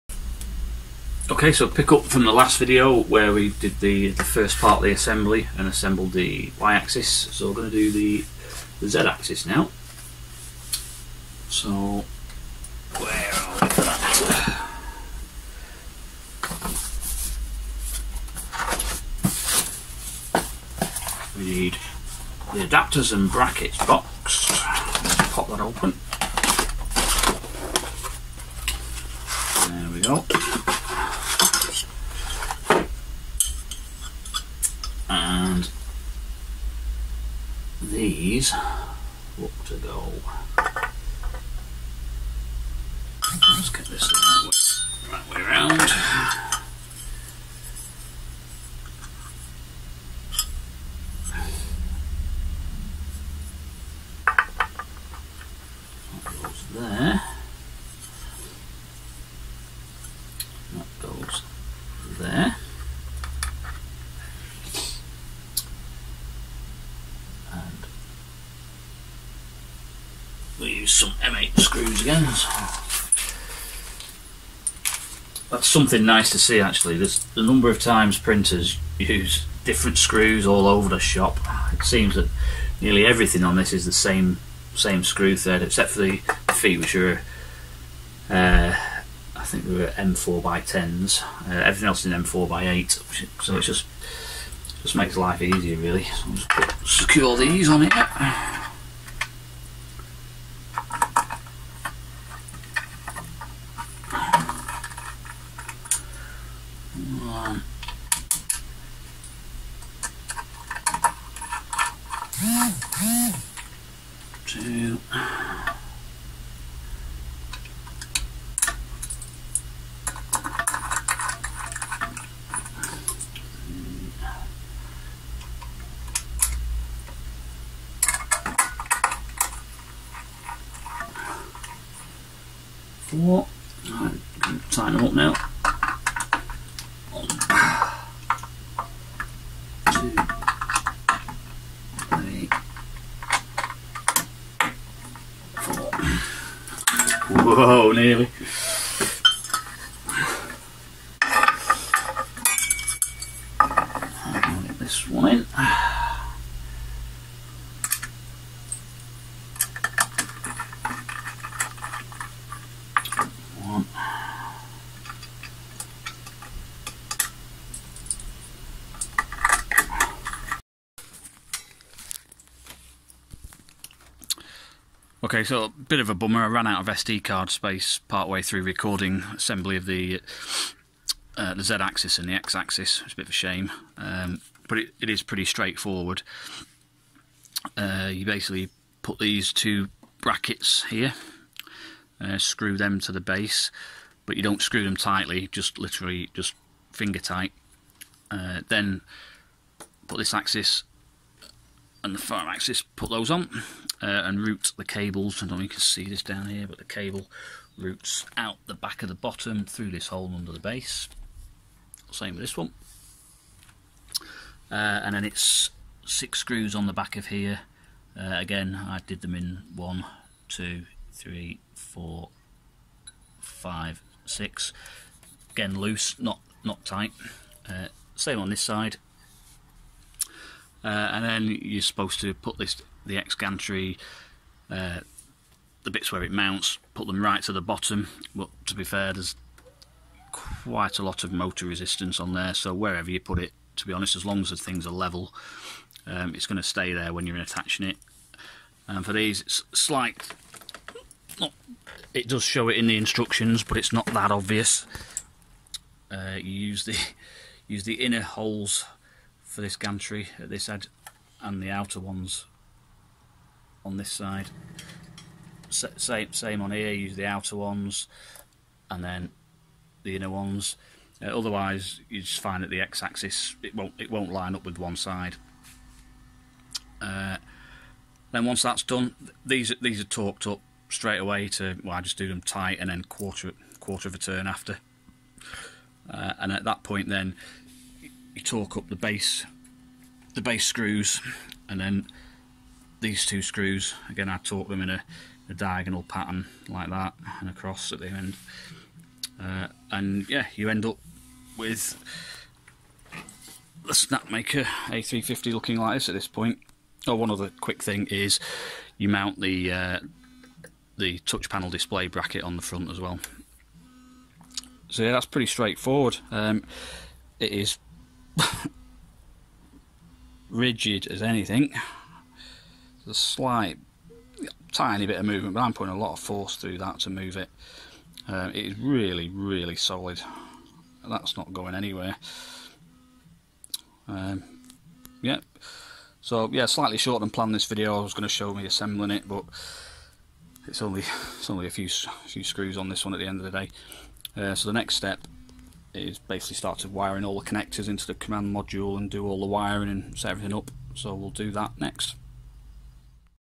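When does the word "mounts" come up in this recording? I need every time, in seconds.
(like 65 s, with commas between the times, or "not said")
236 s, 309 s.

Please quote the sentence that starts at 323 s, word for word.
There's a slight, tiny bit of movement, but I'm putting a lot of force through that to move it.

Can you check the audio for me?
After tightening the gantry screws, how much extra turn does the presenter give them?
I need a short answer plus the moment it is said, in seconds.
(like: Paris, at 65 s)
quarter of a turn, at 283 s.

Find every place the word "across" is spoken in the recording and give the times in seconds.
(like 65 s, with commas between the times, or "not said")
297 s.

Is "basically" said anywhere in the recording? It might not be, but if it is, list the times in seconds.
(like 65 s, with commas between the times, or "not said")
188 s, 346 s.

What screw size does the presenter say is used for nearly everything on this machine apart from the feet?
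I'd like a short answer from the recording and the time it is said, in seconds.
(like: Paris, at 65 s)
M4 by 8, at 92 s.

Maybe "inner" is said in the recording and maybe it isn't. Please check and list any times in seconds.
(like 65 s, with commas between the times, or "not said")
257 s, 270 s.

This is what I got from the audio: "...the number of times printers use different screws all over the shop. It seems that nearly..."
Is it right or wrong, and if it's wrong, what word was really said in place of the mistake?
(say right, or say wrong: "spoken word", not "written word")
right.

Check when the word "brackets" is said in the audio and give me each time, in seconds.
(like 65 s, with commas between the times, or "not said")
23 s, 190 s, 312 s.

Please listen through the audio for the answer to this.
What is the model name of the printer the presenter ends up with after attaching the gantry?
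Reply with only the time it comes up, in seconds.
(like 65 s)
303 s.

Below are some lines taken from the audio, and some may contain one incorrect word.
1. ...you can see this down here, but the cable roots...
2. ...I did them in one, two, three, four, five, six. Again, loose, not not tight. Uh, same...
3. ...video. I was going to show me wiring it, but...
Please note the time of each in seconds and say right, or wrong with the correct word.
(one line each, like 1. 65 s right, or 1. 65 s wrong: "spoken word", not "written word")
1. 205 s right
2. 218 s right
3. 337 s wrong: "assembling", not "wiring".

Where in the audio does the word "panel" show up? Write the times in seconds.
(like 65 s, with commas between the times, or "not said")
311 s.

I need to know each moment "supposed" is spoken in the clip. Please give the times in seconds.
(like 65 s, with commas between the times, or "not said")
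231 s.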